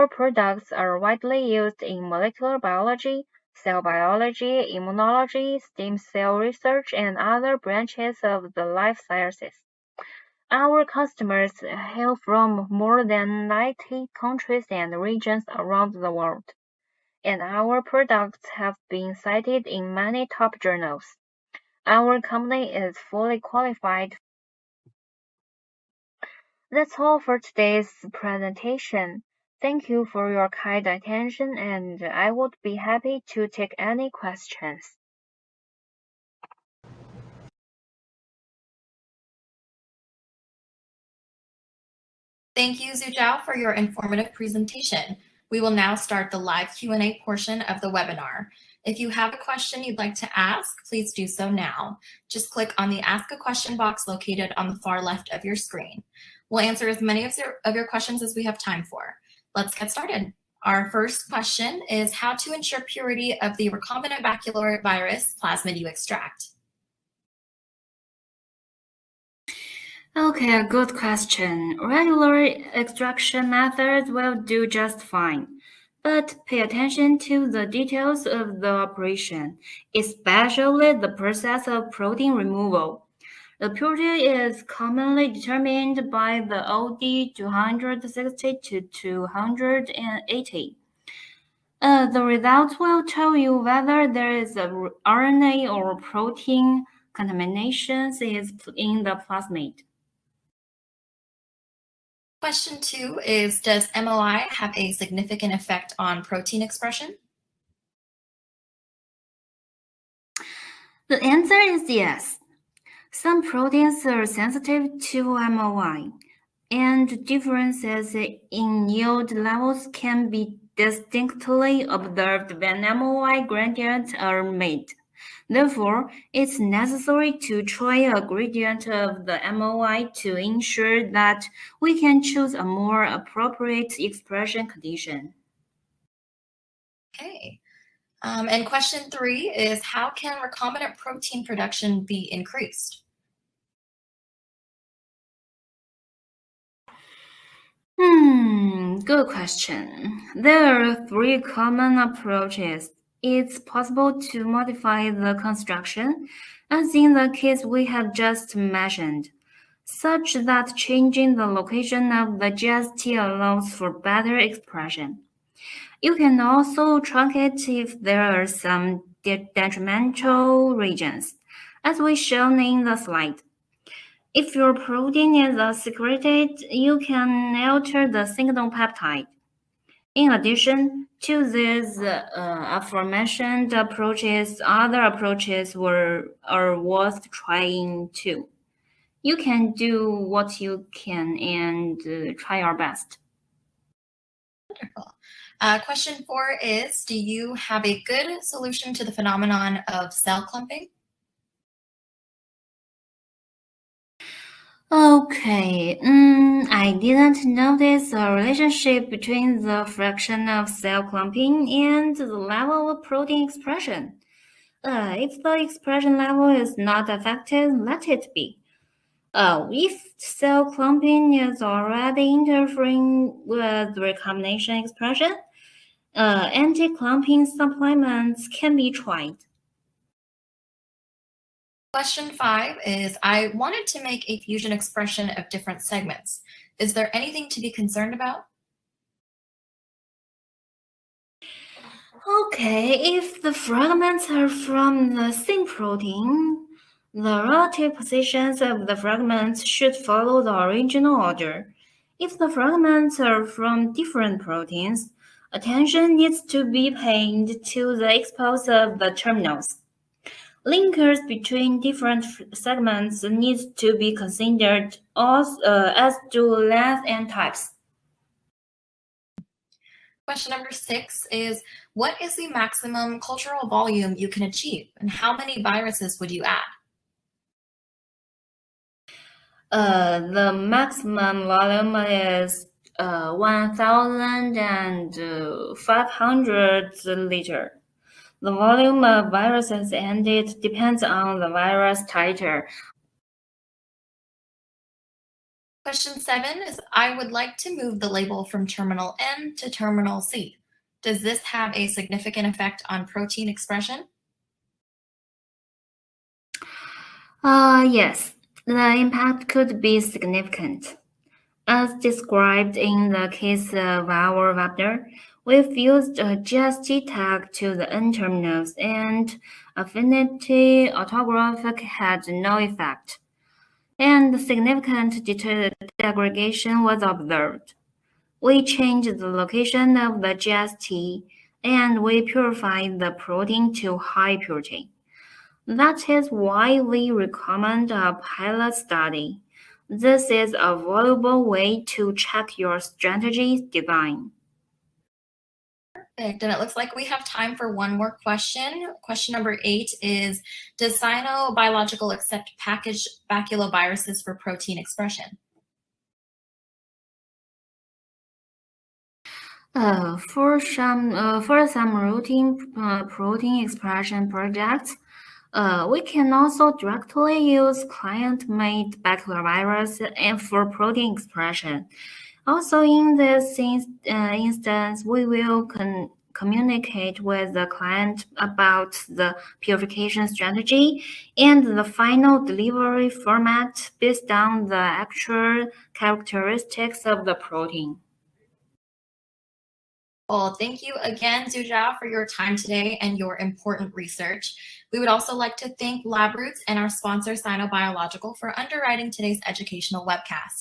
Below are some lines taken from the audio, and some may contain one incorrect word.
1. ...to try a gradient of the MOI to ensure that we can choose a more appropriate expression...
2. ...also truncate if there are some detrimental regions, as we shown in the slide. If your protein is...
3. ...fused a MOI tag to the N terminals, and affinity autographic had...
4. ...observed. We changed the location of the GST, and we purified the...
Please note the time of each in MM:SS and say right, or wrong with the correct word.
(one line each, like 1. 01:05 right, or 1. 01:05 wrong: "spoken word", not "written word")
1. 02:07 right
2. 02:46 right
3. 05:15 wrong: "GST", not "MOI"
4. 05:27 right.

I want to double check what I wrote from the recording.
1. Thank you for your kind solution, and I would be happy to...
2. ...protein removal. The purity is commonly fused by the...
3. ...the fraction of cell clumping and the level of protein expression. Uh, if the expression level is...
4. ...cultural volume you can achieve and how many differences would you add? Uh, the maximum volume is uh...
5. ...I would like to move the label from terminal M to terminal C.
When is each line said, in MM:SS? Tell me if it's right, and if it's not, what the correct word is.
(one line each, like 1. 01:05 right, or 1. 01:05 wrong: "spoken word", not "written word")
1. 00:29 wrong: "attention", not "solution"
2. 01:21 wrong: "determined", not "fused"
3. 03:29 right
4. 04:33 wrong: "viruses", not "differences"
5. 04:56 right.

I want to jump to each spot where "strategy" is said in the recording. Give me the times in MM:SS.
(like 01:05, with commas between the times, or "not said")
05:42, 06:20.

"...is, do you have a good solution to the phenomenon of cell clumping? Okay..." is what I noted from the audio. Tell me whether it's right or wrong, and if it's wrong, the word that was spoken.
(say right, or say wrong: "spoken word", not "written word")
right.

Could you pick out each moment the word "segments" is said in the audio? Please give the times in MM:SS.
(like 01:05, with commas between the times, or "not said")
03:55, 04:22.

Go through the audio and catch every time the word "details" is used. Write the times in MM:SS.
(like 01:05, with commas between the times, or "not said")
01:17.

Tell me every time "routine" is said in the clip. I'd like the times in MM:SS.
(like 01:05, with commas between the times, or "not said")
06:01.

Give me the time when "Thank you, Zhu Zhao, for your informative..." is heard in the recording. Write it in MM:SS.
00:42.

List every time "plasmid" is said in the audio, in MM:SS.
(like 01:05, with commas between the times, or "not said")
01:05, 01:39.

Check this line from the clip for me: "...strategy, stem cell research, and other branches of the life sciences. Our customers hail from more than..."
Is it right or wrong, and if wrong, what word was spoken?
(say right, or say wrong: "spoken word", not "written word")
wrong: "immunology", not "strategy".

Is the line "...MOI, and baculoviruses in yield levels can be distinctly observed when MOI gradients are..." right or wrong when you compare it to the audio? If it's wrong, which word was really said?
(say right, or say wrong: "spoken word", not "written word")
wrong: "differences", not "baculoviruses".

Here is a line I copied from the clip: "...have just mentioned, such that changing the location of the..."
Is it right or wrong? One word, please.
right.